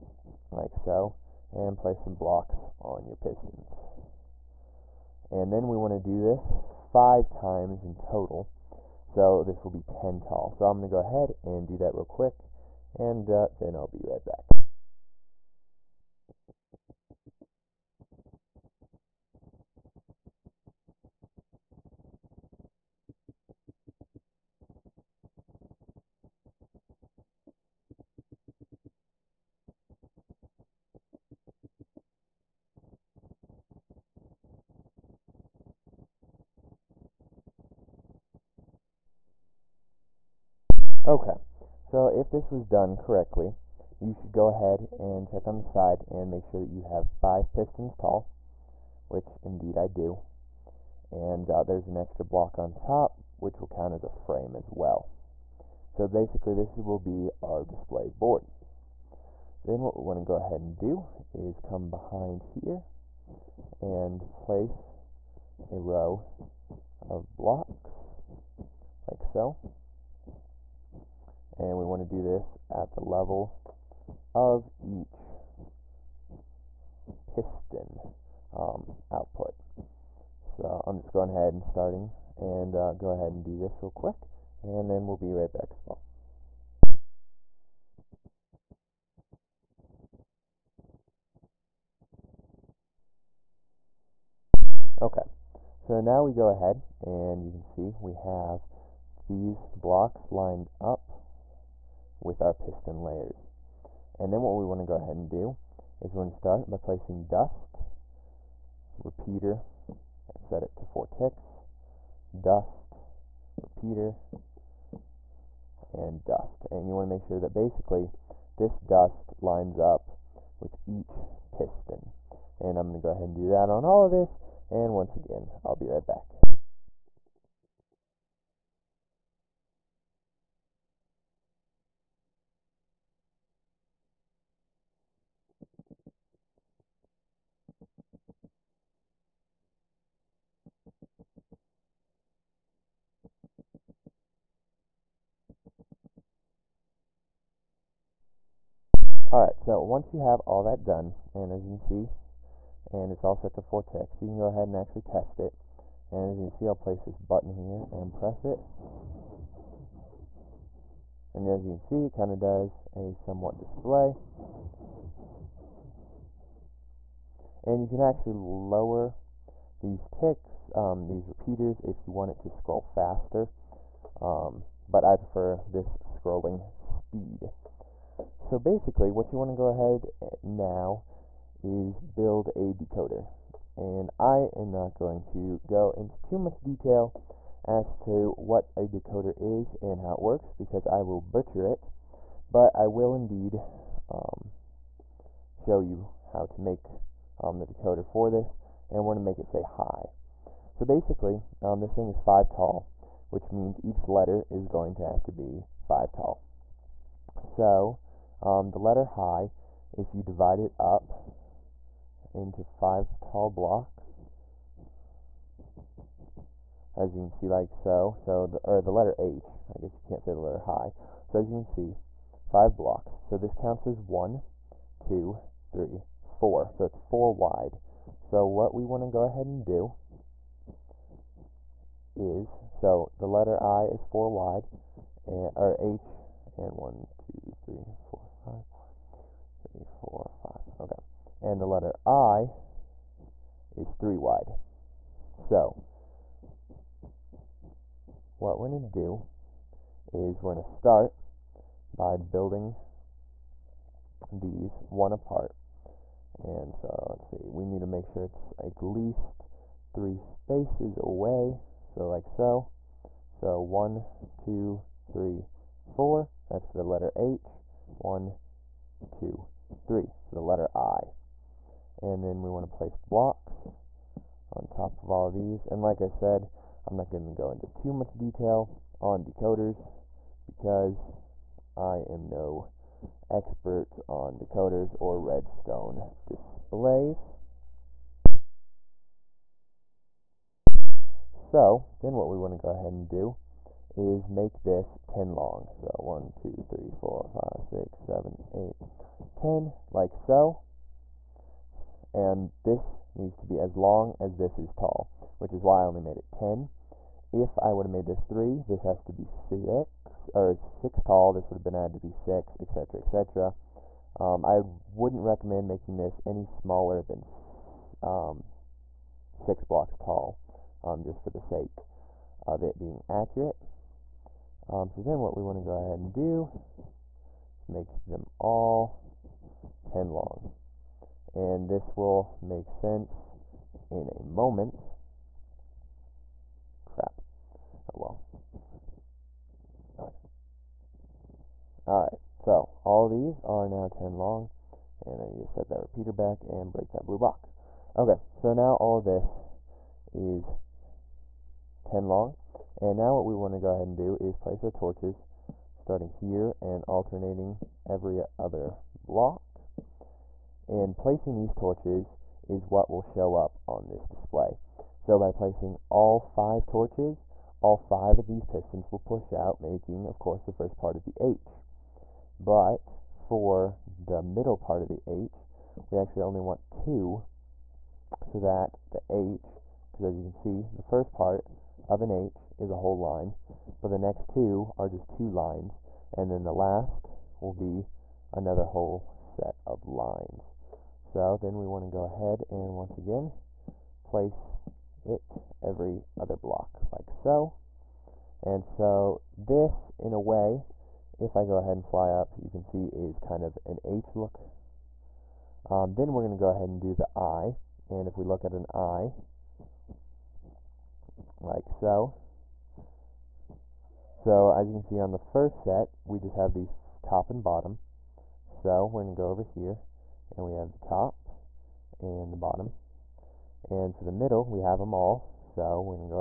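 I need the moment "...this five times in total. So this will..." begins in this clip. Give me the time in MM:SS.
00:06.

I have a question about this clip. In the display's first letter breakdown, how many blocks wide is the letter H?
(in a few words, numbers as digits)
4.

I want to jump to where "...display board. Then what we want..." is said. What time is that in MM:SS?
00:57.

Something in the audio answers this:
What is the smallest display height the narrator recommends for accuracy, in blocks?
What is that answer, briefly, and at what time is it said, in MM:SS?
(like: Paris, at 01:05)
6, at 05:19.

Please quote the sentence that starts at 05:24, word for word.
Um, so then what we want to go ahead and do is make them all 10 long.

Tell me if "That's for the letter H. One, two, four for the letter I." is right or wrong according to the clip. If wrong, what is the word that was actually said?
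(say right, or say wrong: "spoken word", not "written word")
wrong: "three", not "four".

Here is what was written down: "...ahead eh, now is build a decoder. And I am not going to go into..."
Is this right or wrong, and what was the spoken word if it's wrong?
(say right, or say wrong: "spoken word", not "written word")
right.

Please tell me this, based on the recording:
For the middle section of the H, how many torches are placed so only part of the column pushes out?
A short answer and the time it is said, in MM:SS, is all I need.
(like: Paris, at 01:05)
2, at 06:16.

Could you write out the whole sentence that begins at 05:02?
And this needs to be as long as this is tall, which is why I only made it 10.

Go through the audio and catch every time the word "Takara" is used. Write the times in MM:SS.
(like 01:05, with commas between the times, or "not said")
not said.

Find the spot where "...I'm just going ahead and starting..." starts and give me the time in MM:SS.
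01:20.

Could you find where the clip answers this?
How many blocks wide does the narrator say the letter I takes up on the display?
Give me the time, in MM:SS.
04:03.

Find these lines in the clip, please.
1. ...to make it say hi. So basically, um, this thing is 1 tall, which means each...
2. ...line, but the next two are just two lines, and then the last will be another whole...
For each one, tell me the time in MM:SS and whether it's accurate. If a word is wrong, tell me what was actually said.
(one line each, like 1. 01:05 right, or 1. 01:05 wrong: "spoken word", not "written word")
1. 03:19 wrong: "5", not "1"
2. 06:22 right.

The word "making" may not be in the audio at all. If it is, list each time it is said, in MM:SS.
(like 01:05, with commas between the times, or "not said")
05:15, 06:09.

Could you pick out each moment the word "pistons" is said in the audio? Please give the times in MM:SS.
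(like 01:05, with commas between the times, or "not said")
00:03, 00:47, 01:17, 01:42, 02:01, 06:08.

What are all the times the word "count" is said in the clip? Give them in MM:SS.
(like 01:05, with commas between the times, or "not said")
00:53, 03:43.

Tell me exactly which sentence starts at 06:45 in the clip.
Um, then we're going to go ahead and do the I and if we look at an I like so.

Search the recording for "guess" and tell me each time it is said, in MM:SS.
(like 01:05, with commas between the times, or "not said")
03:39.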